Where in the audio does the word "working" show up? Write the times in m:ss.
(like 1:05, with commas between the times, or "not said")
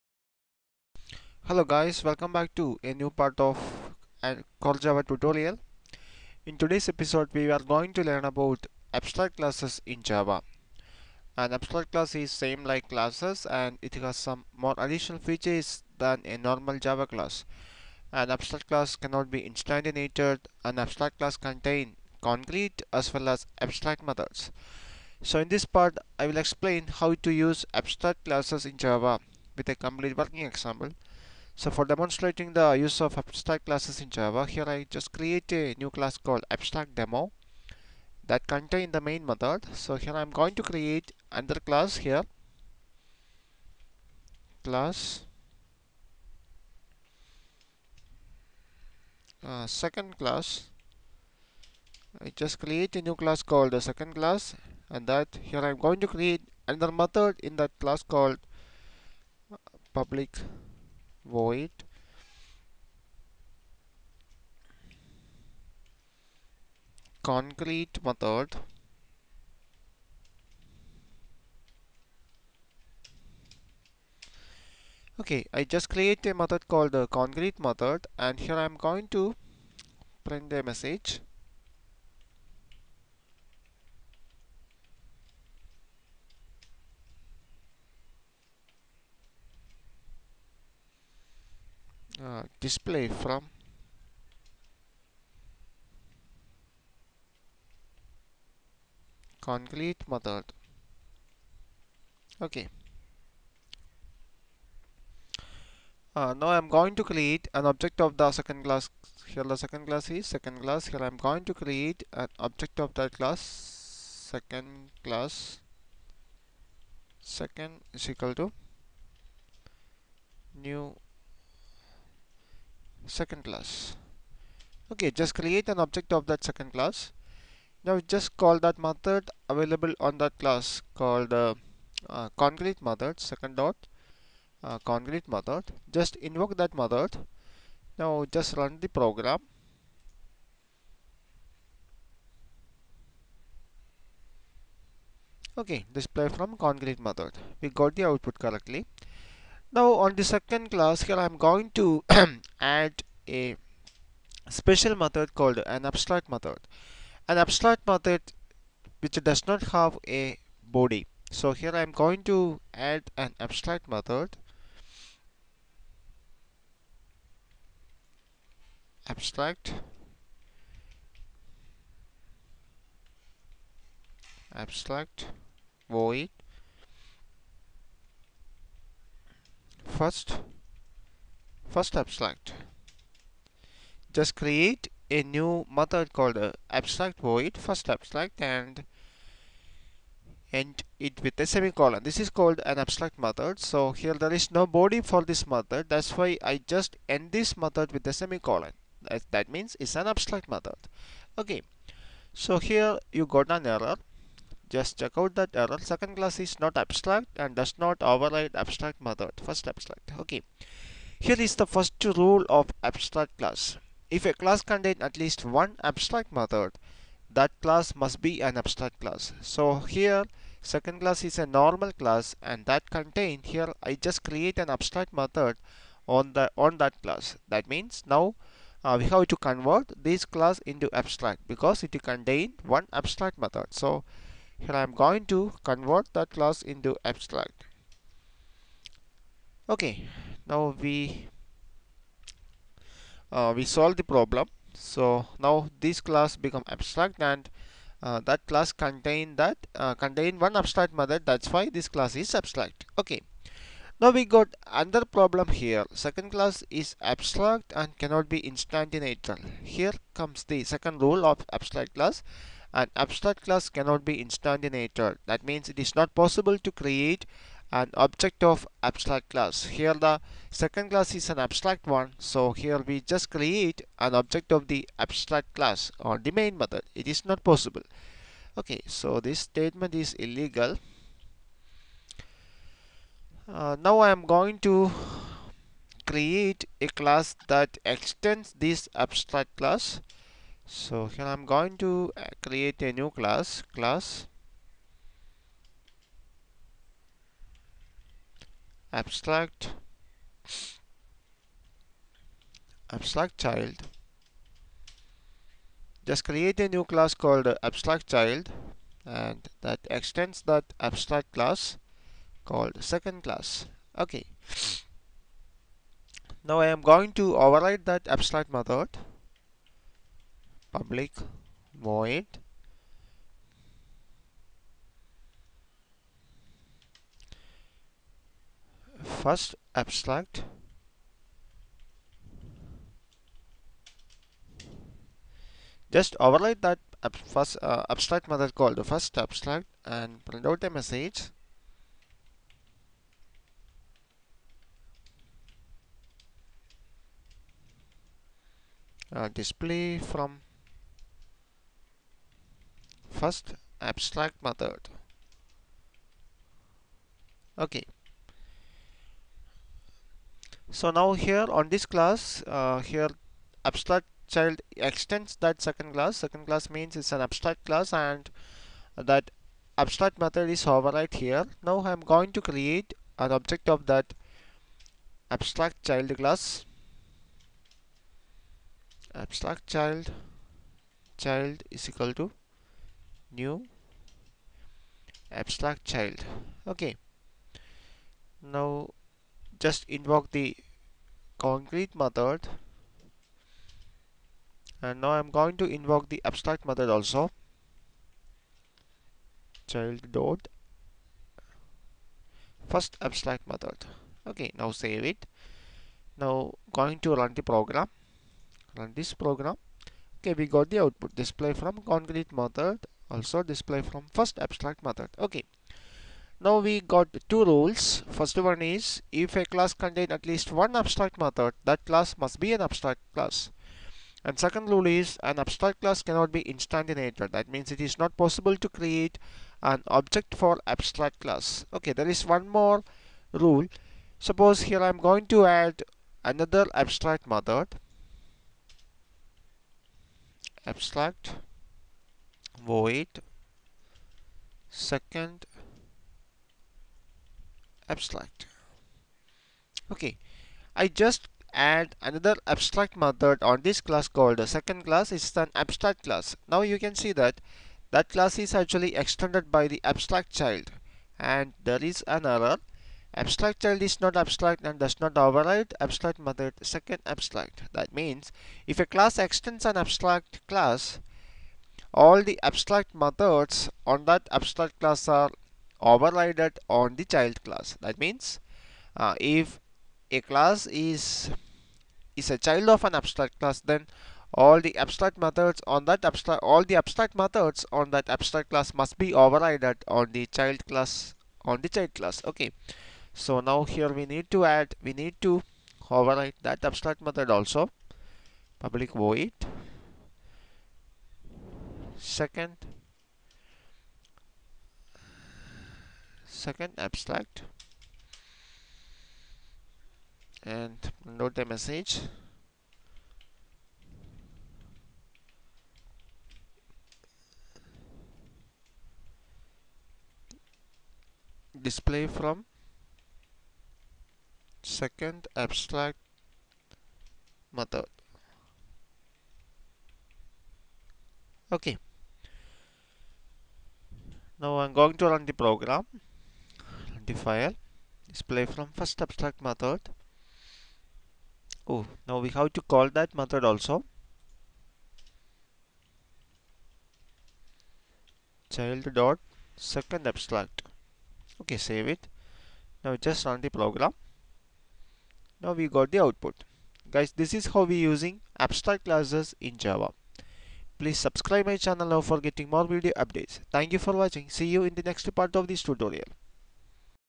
0:30.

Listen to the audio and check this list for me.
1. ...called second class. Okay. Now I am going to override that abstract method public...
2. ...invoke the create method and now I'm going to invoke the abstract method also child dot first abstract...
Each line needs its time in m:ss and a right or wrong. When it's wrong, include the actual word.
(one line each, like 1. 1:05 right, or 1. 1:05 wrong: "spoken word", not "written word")
1. 5:12 right
2. 6:29 wrong: "concrete", not "create".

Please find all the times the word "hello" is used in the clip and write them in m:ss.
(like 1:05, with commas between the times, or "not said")
0:01.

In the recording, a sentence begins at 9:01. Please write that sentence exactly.
Oh, now we have to call that method also.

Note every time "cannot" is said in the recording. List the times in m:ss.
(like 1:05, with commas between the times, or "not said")
0:18, 4:17, 4:23, 7:06.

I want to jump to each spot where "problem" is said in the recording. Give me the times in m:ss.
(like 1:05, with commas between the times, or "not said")
4:04, 4:15.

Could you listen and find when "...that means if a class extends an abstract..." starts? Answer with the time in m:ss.
7:47.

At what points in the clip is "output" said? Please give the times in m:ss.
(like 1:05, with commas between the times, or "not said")
2:28, 6:50, 9:16.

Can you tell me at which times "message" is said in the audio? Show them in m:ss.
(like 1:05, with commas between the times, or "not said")
1:20, 5:40, 8:31.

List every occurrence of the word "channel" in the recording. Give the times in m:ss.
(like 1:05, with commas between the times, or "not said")
9:21.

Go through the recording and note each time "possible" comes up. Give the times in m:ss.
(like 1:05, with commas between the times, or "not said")
4:26, 4:37, 7:08.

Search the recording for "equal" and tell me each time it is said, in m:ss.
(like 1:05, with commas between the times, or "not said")
1:58, 6:21.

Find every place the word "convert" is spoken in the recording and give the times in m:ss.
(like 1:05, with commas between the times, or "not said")
3:49, 3:55.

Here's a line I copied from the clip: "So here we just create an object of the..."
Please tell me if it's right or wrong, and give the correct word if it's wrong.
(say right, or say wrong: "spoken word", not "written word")
right.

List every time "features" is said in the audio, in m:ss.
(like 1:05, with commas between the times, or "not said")
0:15.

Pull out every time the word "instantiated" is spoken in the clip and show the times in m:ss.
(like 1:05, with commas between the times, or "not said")
0:19, 4:18, 4:24, 7:06.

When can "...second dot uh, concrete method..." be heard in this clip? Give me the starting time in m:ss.
2:13.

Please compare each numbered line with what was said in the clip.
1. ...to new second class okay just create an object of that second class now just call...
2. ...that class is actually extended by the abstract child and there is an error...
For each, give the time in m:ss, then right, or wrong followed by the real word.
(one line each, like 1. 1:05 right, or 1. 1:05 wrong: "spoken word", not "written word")
1. 1:58 right
2. 7:37 right.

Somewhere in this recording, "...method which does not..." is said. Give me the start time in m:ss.
2:37.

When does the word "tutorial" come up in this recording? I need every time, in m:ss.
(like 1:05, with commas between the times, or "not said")
0:05, 9:25.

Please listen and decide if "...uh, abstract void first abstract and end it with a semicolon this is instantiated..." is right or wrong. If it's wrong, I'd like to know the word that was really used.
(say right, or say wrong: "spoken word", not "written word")
wrong: "called", not "instantiated".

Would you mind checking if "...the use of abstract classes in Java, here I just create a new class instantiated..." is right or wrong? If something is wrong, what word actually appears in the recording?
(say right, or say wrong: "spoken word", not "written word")
wrong: "called", not "instantiated".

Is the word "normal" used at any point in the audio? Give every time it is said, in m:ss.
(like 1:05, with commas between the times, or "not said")
0:16, 3:41.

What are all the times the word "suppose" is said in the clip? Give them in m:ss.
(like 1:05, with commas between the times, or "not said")
7:14.